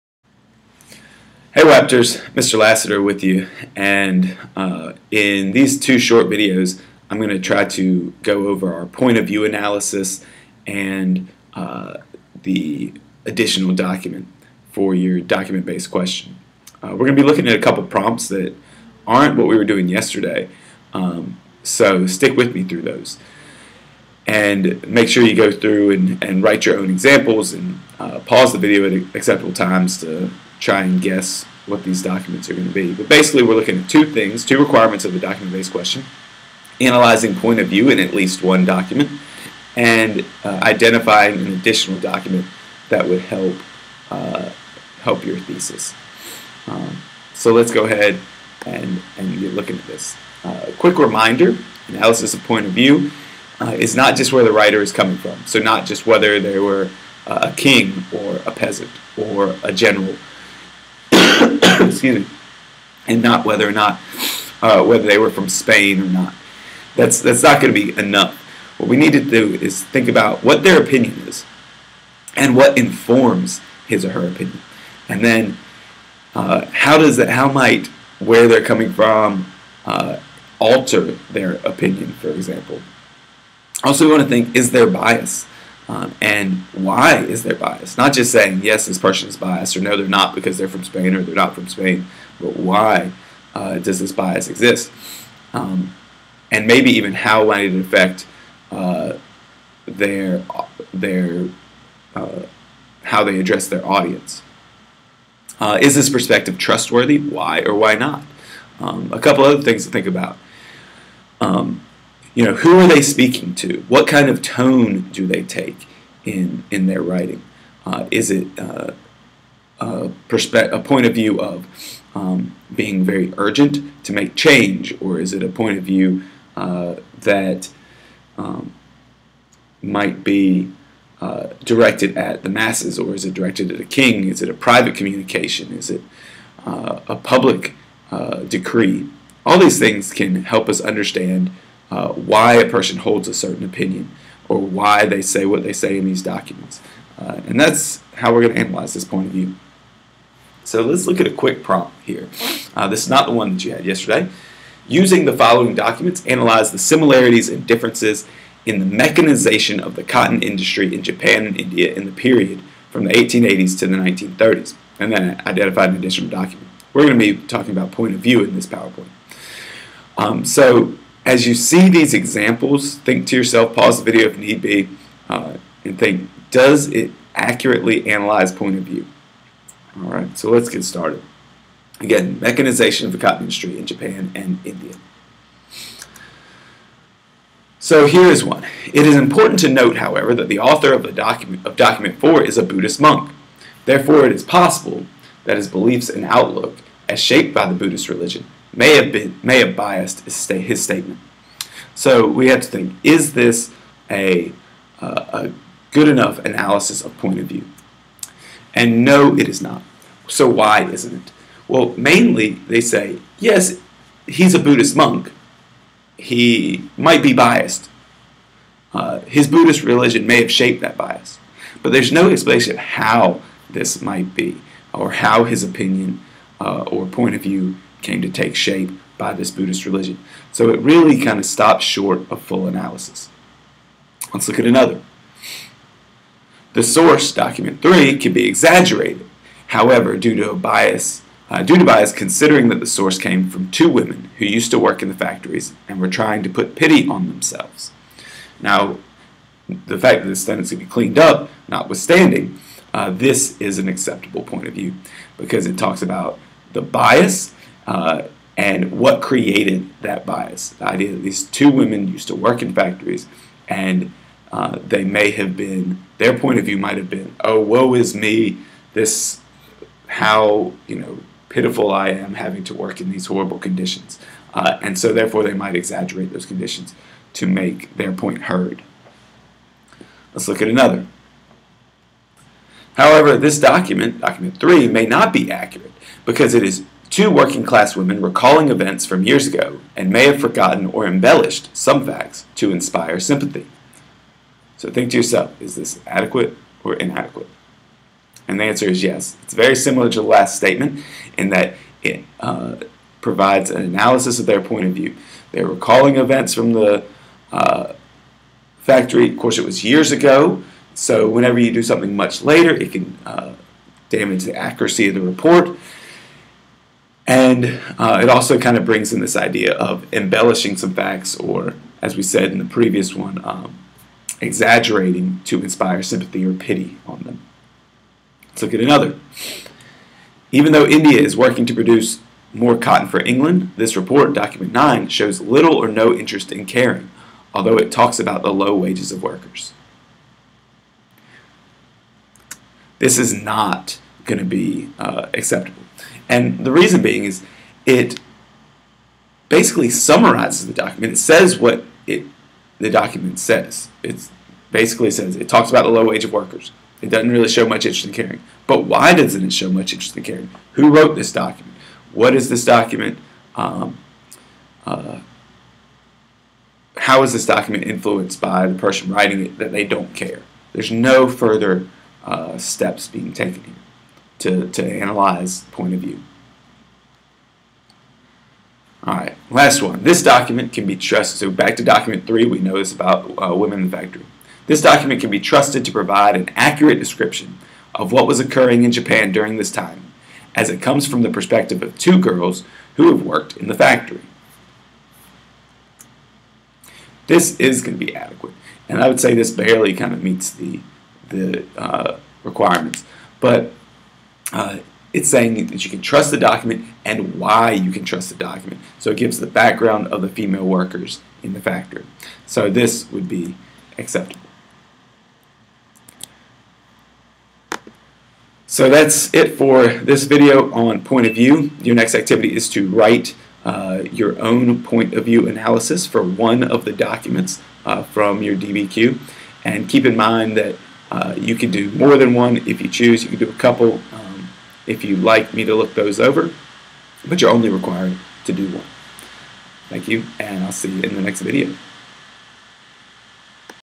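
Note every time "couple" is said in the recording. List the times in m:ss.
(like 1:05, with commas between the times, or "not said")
0:17, 1:49, 7:13.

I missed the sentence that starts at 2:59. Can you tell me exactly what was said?
All right, so let's get started.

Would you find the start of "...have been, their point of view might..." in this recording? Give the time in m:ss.
4:25.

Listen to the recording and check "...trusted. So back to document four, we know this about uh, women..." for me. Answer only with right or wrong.
wrong.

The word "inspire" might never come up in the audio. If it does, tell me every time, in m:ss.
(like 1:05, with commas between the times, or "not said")
4:52, 5:25.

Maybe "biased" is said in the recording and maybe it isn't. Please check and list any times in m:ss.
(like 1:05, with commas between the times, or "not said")
1:29, 3:19, 3:37.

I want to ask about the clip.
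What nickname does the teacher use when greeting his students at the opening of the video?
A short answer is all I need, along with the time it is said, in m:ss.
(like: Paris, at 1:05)
Raptors, at 0:01.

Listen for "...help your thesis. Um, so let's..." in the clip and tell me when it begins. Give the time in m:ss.
0:45.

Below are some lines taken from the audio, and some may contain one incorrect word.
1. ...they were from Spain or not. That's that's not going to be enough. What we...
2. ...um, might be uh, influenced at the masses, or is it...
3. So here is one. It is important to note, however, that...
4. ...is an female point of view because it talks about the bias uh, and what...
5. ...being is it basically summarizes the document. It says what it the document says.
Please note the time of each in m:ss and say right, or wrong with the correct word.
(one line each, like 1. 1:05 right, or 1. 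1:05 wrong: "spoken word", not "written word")
1. 1:05 right
2. 2:08 wrong: "directed", not "influenced"
3. 3:07 right
4. 4:13 wrong: "acceptable", not "female"
5. 5:47 right.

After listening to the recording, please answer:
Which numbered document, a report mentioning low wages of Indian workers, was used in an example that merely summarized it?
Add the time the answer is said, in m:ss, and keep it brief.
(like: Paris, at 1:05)
9, at 5:34.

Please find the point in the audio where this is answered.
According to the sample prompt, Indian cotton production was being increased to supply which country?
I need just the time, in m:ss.
5:33.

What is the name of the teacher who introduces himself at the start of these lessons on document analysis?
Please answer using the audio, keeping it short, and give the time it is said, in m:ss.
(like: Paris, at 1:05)
Mr. Lasseter, at 0:02.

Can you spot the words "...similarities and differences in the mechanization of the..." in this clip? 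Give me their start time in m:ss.
2:36.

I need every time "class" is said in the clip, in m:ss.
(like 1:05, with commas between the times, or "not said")
4:47.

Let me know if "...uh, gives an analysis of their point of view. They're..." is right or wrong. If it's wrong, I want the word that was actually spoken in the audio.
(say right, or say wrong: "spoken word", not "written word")
wrong: "provides", not "gives".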